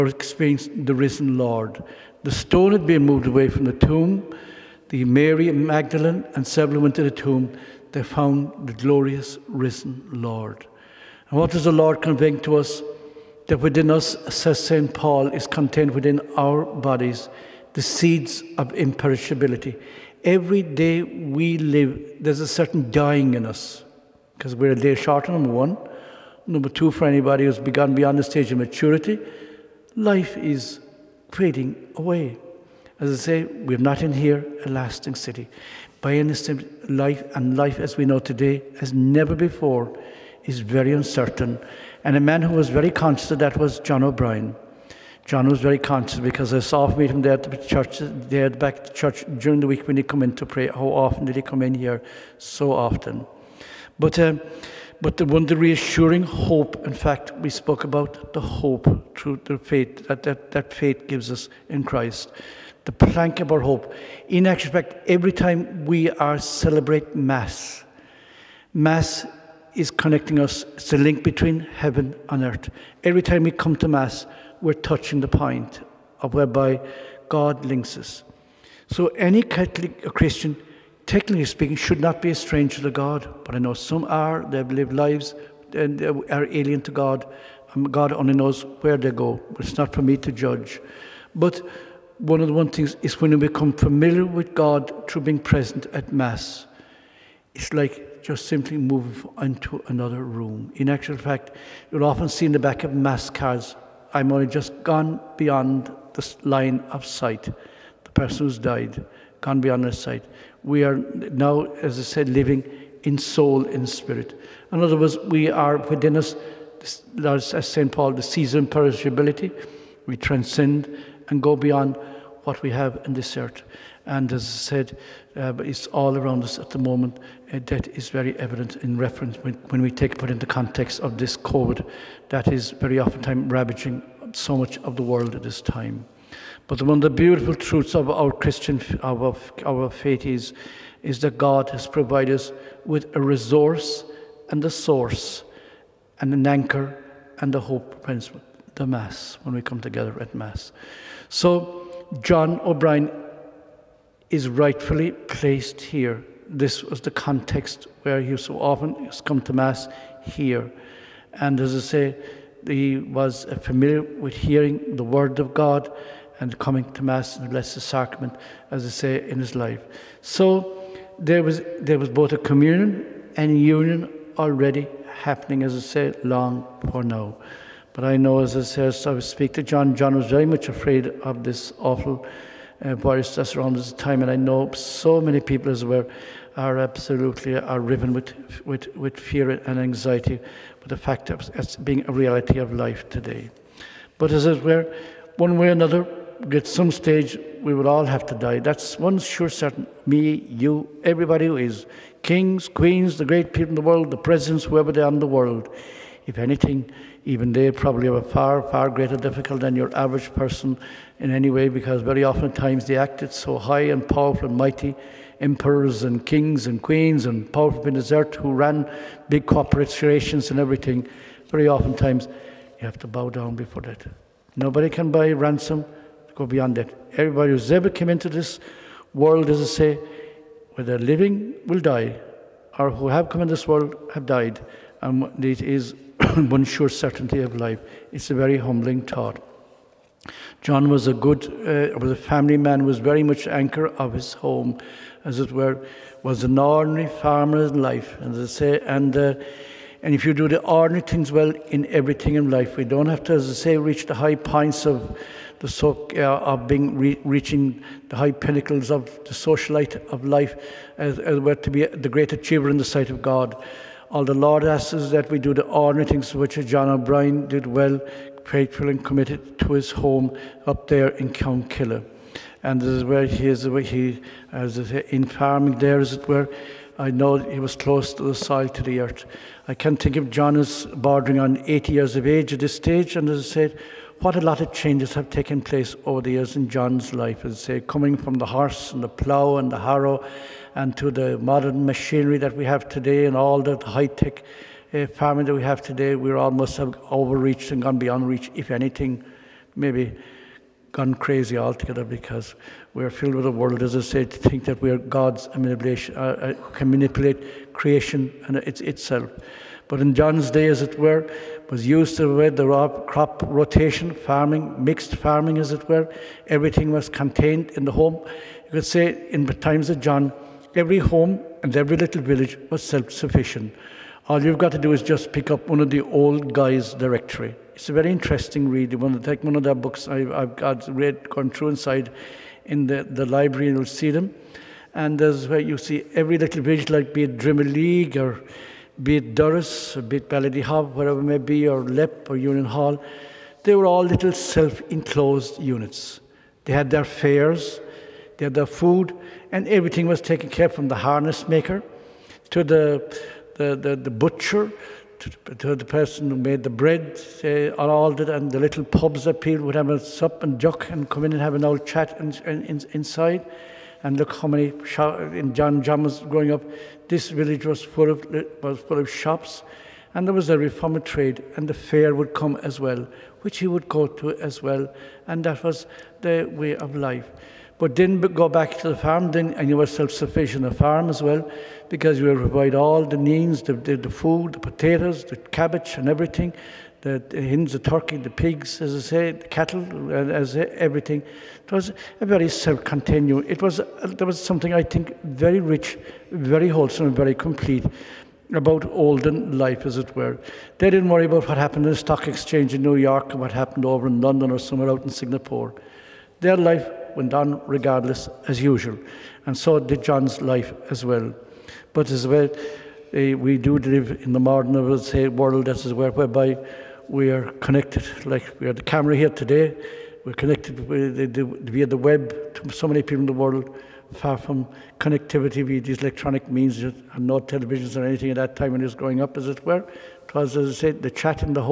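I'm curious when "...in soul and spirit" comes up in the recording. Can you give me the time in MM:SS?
01:53.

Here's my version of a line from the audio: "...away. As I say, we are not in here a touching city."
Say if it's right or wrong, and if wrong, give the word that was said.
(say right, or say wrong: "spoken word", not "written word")
wrong: "lasting", not "touching".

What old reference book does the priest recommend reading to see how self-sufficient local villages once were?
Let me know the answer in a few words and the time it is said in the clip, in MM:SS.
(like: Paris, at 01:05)
Guy's directory, at 05:26.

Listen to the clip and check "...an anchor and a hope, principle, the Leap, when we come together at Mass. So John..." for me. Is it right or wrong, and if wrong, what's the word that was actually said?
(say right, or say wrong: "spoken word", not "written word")
wrong: "Mass", not "Leap".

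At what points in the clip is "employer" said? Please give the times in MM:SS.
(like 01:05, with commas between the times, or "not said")
not said.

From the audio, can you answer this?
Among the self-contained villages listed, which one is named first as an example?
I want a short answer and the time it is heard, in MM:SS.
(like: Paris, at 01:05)
Drimoleague, at 05:37.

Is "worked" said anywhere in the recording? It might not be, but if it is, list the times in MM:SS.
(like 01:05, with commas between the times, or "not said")
not said.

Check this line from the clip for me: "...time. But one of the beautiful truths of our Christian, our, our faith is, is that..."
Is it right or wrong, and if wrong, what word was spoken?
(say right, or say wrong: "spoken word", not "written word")
right.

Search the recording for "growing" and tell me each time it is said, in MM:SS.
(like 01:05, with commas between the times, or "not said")
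06:06, 07:08.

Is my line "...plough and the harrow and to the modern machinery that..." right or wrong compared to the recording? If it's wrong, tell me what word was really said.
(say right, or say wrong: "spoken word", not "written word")
right.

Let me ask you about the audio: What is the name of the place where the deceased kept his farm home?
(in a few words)
Counkilla.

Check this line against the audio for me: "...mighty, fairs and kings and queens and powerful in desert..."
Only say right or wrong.
wrong.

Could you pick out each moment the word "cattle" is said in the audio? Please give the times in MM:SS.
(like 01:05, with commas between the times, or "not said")
06:29.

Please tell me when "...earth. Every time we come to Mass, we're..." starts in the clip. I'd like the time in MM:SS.
01:12.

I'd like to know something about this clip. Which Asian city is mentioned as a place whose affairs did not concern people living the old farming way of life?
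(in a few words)
Singapore.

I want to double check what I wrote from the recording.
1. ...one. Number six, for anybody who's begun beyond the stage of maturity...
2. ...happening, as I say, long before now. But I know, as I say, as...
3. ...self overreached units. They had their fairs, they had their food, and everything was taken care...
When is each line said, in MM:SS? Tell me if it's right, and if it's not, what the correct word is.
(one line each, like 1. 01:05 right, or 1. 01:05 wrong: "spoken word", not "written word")
1. 00:25 wrong: "two", not "six"
2. 02:55 right
3. 05:44 wrong: "enclosed", not "overreached".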